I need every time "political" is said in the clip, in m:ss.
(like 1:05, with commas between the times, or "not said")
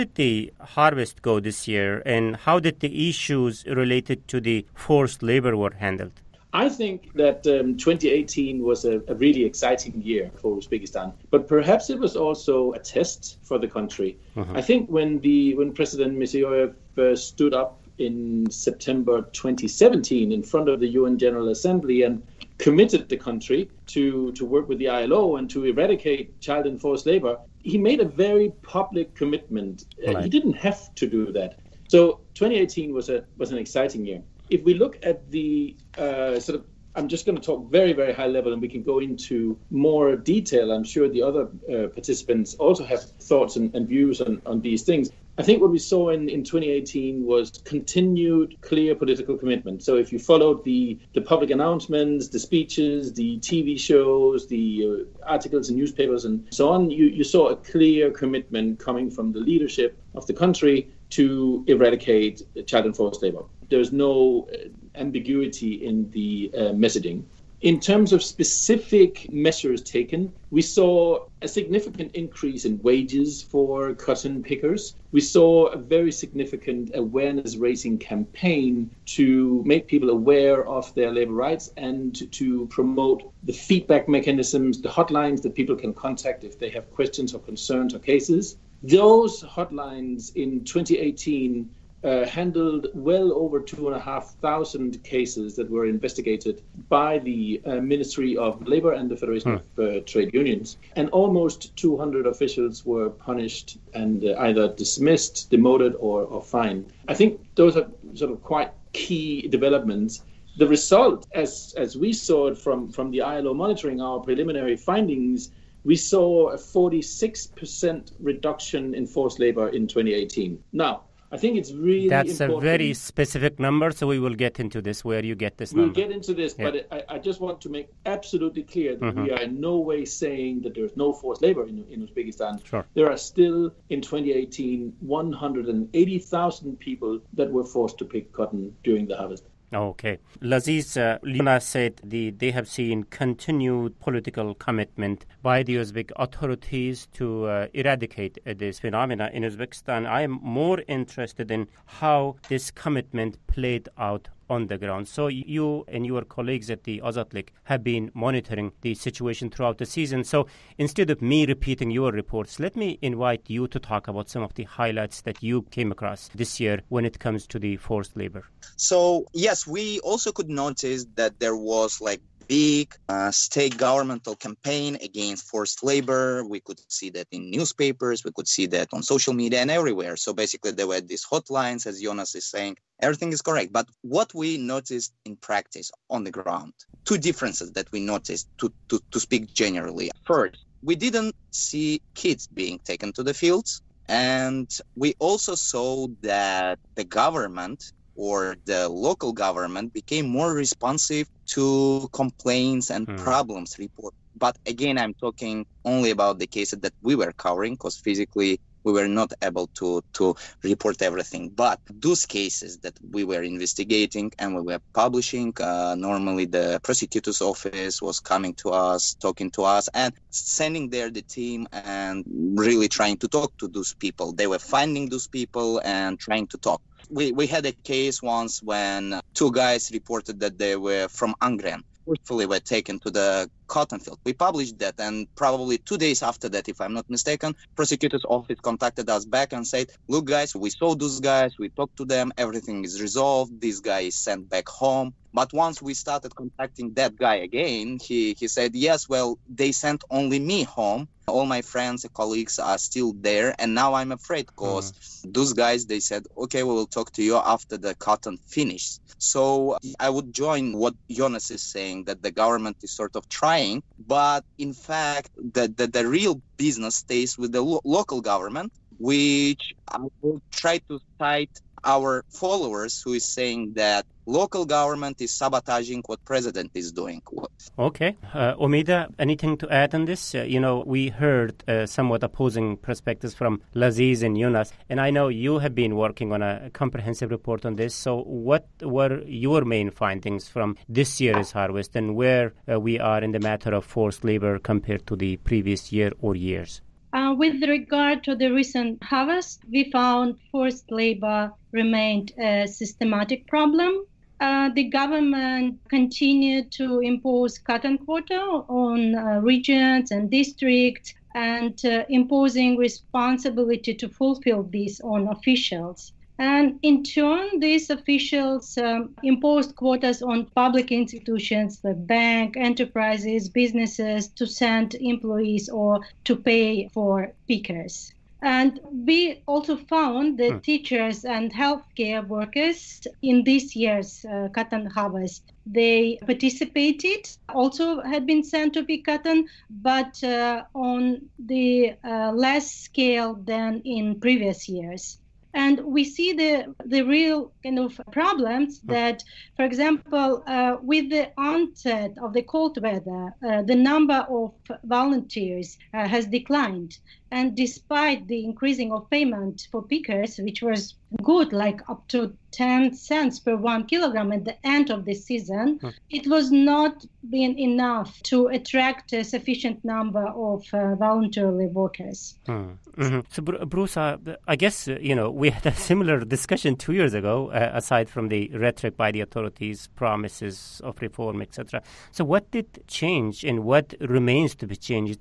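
0:48, 2:23.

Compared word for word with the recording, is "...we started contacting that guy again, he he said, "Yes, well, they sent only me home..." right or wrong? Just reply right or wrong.
right.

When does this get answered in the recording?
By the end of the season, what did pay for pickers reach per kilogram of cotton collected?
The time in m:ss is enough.
6:02.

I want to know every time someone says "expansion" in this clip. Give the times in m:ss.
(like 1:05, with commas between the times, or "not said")
not said.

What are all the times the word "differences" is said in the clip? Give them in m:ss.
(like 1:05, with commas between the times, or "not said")
3:07.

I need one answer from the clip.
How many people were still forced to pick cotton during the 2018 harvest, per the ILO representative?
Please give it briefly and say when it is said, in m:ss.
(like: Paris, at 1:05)
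180,000, at 2:14.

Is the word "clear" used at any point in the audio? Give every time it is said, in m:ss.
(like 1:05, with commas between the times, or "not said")
0:48, 0:57, 2:08.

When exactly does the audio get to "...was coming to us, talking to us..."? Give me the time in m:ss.
3:38.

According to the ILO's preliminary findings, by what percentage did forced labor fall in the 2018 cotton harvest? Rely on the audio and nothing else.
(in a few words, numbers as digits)
46%.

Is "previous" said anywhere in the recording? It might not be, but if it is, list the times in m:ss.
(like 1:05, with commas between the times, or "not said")
4:55, 5:44.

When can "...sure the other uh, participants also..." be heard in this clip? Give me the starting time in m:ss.
0:40.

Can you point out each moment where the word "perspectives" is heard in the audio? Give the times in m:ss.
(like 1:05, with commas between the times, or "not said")
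4:42.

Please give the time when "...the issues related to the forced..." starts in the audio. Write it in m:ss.
0:02.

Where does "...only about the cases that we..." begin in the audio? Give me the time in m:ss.
3:25.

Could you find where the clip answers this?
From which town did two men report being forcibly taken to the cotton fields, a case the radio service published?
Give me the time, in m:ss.
3:51.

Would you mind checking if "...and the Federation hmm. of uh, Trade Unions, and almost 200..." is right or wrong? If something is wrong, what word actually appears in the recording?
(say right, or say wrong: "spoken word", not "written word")
right.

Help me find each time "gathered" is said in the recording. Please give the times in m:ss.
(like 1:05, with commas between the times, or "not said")
not said.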